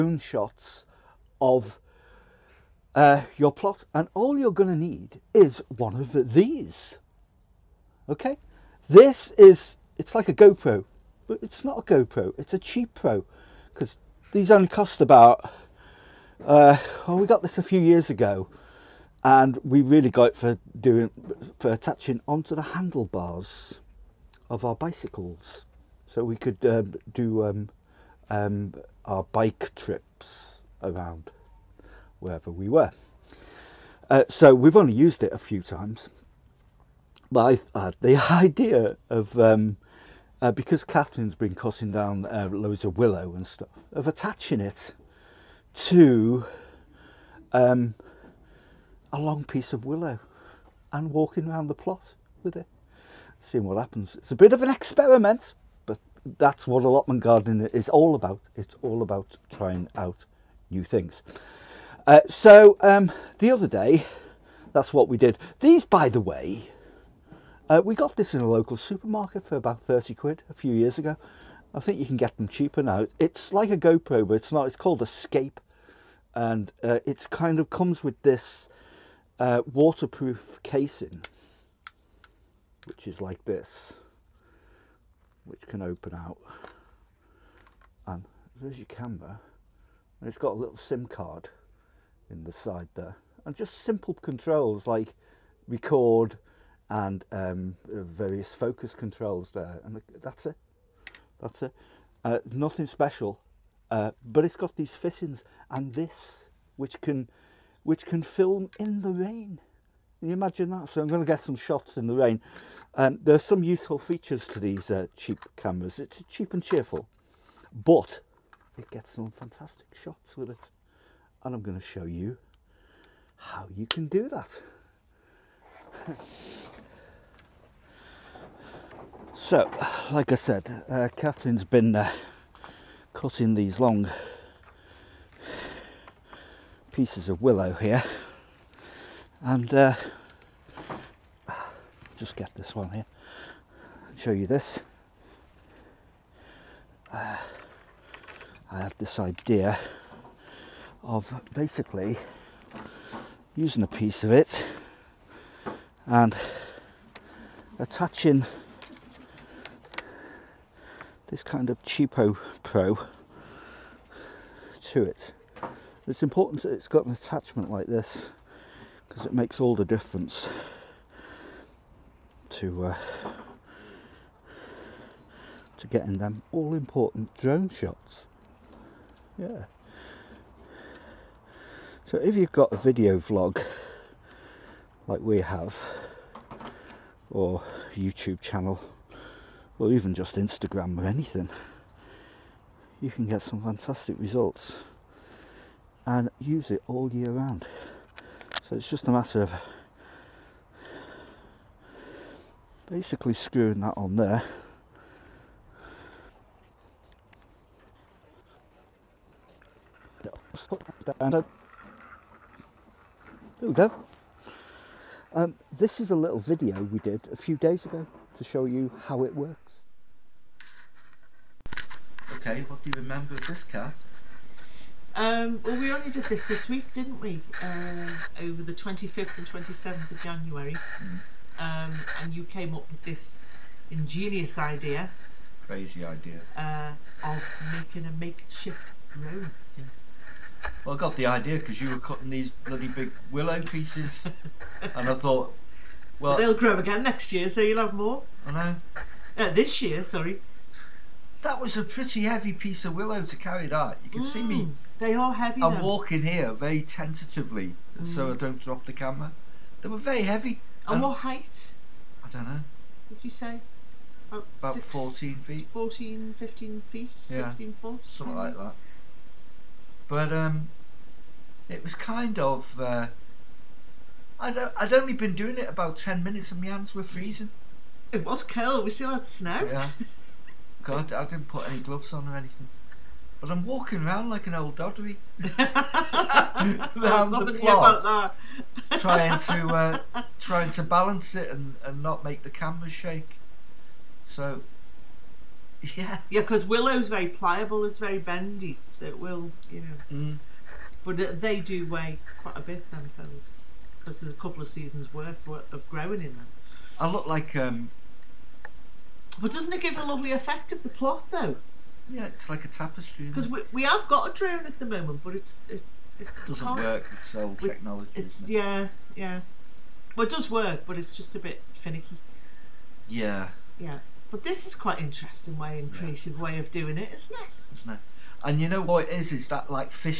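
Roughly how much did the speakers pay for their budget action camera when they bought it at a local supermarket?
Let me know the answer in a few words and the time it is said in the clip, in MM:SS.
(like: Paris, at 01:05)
30 quid, at 01:09.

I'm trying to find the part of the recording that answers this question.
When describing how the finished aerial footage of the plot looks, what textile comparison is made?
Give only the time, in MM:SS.
05:12.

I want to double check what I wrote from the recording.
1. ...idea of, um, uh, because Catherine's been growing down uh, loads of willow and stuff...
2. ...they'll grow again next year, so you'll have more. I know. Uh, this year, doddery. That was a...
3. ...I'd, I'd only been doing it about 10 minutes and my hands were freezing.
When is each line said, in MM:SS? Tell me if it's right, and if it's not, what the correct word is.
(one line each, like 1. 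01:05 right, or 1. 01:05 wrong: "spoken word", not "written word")
1. 00:38 wrong: "cutting", not "growing"
2. 04:06 wrong: "sorry", not "doddery"
3. 04:34 right.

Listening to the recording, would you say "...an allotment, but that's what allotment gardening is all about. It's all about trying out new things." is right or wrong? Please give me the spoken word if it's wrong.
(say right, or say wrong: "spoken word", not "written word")
wrong: "experiment", not "allotment".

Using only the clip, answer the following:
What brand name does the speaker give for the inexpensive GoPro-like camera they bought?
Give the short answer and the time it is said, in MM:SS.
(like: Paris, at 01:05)
Escape, at 01:15.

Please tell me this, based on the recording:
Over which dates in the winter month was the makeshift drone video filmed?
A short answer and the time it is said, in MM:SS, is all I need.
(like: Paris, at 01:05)
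25th and 27th of January, at 03:48.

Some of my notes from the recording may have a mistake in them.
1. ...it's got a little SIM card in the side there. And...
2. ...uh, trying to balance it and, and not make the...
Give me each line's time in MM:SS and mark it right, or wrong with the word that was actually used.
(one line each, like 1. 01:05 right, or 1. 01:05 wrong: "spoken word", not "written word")
1. 01:30 right
2. 04:49 right.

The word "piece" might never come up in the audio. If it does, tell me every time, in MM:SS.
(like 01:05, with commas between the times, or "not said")
00:49, 02:16, 02:33, 04:03, 04:12.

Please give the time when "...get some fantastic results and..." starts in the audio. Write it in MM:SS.
03:13.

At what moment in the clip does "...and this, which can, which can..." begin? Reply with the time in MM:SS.
01:45.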